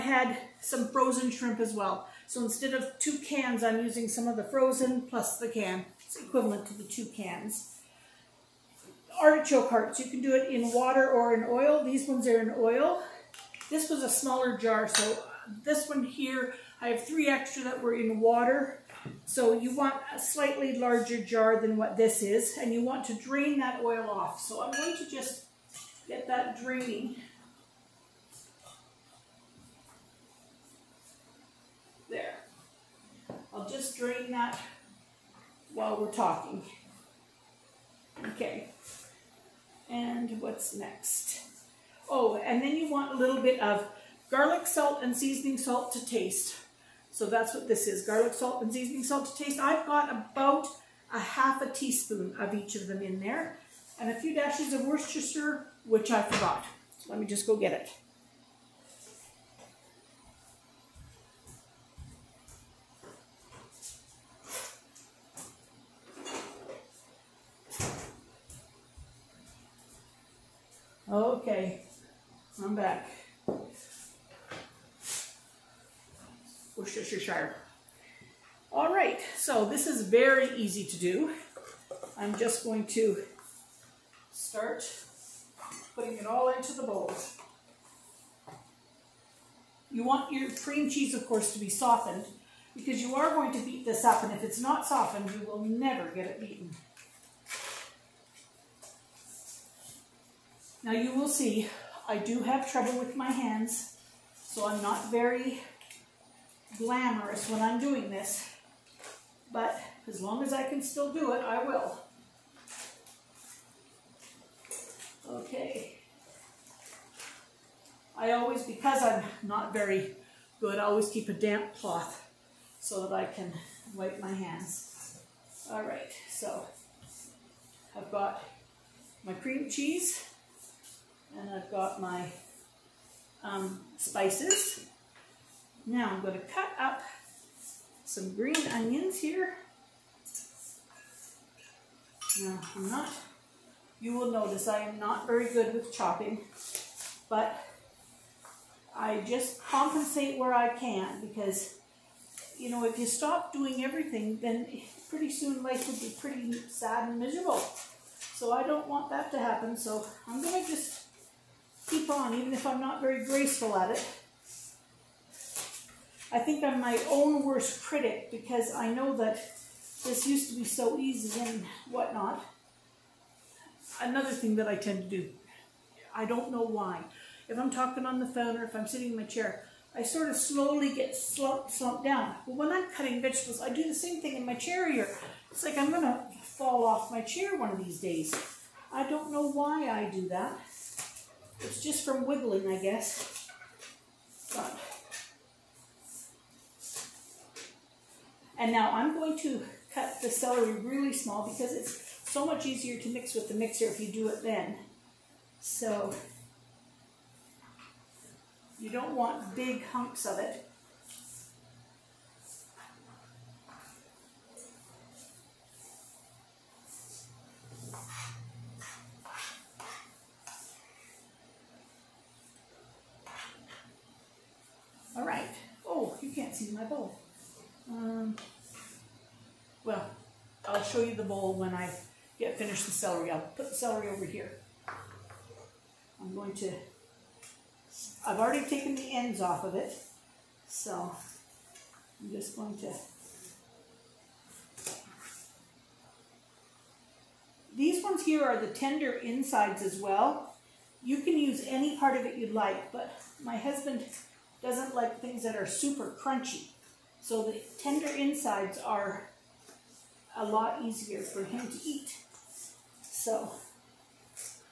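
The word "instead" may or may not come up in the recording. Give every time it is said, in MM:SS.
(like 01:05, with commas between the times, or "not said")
00:02.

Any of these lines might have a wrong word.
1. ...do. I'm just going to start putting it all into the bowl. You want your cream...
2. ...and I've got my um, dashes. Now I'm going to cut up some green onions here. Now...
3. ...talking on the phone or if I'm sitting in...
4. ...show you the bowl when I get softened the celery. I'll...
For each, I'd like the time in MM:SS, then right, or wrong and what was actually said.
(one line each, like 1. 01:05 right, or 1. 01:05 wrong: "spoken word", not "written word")
1. 01:21 right
2. 02:11 wrong: "spices", not "dashes"
3. 02:57 right
4. 03:50 wrong: "finished", not "softened".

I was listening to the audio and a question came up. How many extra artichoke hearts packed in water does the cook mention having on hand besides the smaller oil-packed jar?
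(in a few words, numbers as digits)
3.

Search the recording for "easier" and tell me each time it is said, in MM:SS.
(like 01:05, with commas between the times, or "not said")
03:22, 04:20.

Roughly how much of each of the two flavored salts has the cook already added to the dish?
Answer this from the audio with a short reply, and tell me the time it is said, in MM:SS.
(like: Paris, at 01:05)
half a teaspoon, at 00:51.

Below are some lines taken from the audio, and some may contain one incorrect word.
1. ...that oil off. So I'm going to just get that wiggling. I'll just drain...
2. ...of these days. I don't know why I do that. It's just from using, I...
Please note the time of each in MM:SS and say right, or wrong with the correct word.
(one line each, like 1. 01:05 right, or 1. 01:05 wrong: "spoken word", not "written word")
1. 00:23 wrong: "draining", not "wiggling"
2. 03:07 wrong: "wiggling", not "using".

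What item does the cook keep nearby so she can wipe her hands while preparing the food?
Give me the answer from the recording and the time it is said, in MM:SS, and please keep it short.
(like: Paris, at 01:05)
damp cloth, at 02:01.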